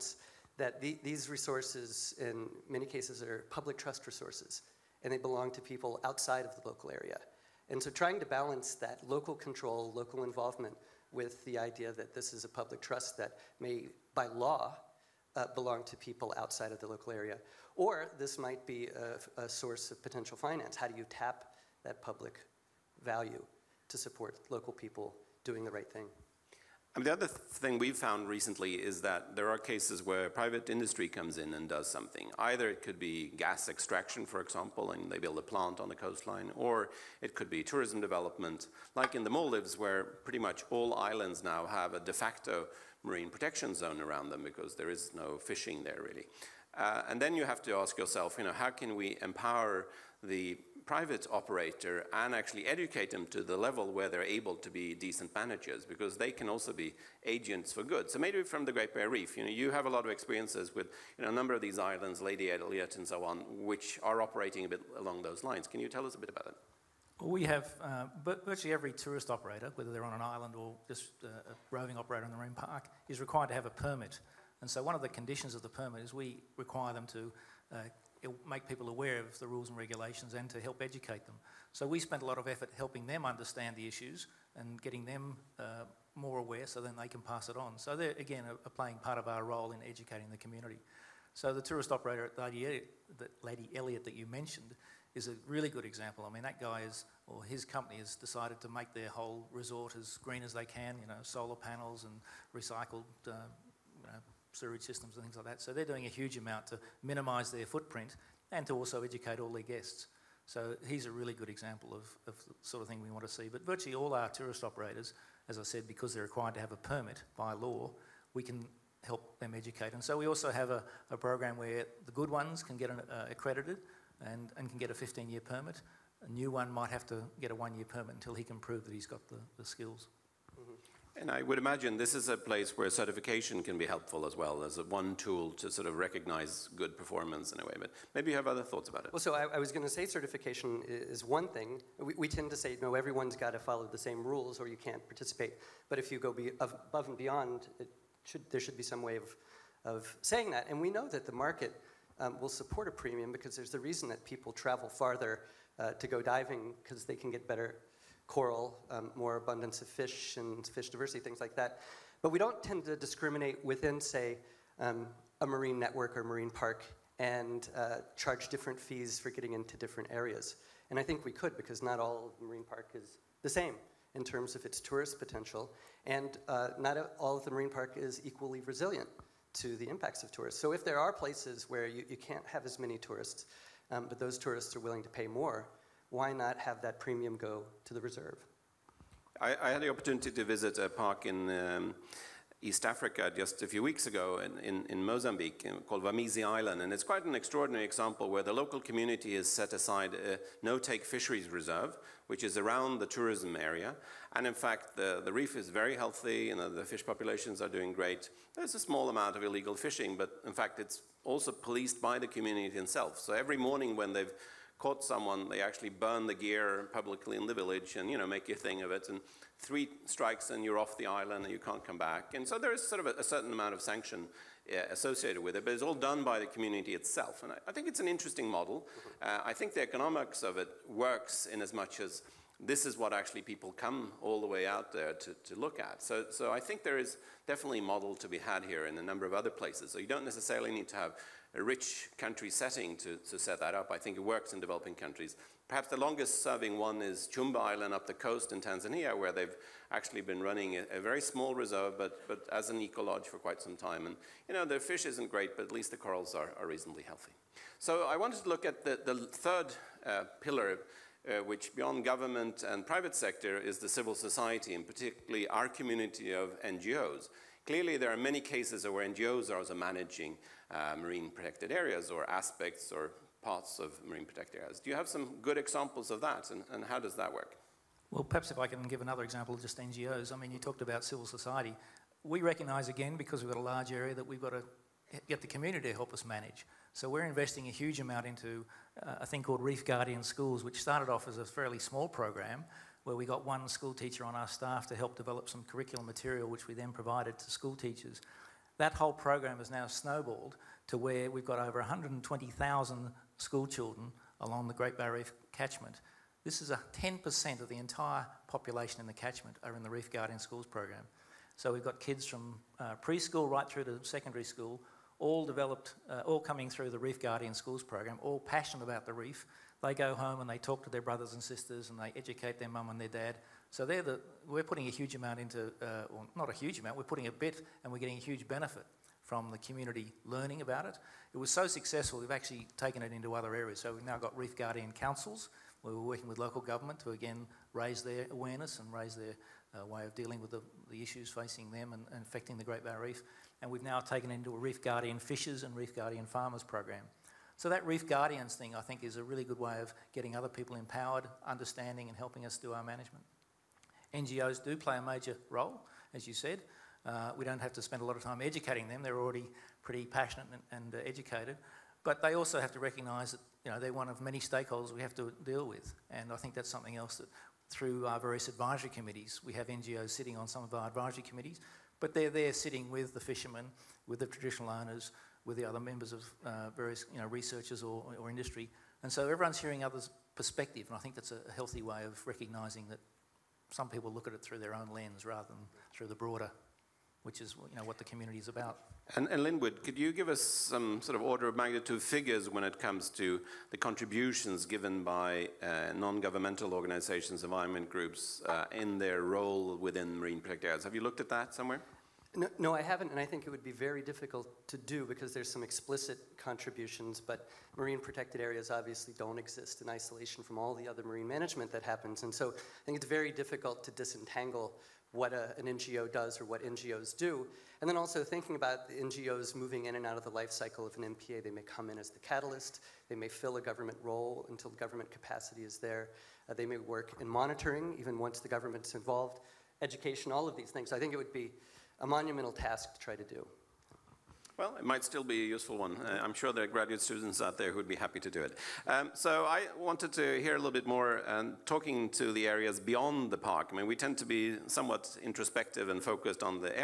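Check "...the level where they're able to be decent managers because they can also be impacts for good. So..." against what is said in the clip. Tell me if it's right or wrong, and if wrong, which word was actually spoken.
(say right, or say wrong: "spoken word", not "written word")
wrong: "agents", not "impacts".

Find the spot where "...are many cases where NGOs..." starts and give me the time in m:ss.
4:28.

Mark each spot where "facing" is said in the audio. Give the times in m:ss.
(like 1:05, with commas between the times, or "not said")
5:41.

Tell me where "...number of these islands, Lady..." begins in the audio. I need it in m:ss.
1:01.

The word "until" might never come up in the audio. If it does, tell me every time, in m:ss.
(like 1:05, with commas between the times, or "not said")
2:08, 7:04.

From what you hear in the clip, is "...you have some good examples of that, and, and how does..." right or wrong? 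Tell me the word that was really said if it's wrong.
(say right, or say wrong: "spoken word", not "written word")
right.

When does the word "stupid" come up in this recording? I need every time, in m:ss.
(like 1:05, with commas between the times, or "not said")
not said.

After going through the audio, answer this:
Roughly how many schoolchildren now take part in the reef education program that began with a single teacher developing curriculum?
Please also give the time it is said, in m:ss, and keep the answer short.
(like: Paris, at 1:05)
120,000, at 5:01.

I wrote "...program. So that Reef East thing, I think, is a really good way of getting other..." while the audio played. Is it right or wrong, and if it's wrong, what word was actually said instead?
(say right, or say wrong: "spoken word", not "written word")
wrong: "Guardians", not "East".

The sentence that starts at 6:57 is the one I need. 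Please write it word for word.
And then also thinking about the NGOs moving in and out of the life cycle of an MPA.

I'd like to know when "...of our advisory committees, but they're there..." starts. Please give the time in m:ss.
6:10.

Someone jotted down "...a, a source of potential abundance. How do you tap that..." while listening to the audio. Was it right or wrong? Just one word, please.
wrong.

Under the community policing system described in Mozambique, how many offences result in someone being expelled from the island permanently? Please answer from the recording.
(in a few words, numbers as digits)
3.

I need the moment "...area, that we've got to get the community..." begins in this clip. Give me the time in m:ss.
4:43.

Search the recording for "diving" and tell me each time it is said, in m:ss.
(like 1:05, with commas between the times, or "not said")
2:36.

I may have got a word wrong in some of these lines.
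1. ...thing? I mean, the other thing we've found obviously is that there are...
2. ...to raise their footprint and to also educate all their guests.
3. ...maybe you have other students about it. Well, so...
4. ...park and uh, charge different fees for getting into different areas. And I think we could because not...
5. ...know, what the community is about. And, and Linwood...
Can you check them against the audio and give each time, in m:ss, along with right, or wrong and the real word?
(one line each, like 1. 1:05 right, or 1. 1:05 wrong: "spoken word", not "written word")
1. 0:25 wrong: "recently", not "obviously"
2. 1:46 wrong: "minimise", not "raise"
3. 2:18 wrong: "thoughts", not "students"
4. 2:46 right
5. 6:27 right.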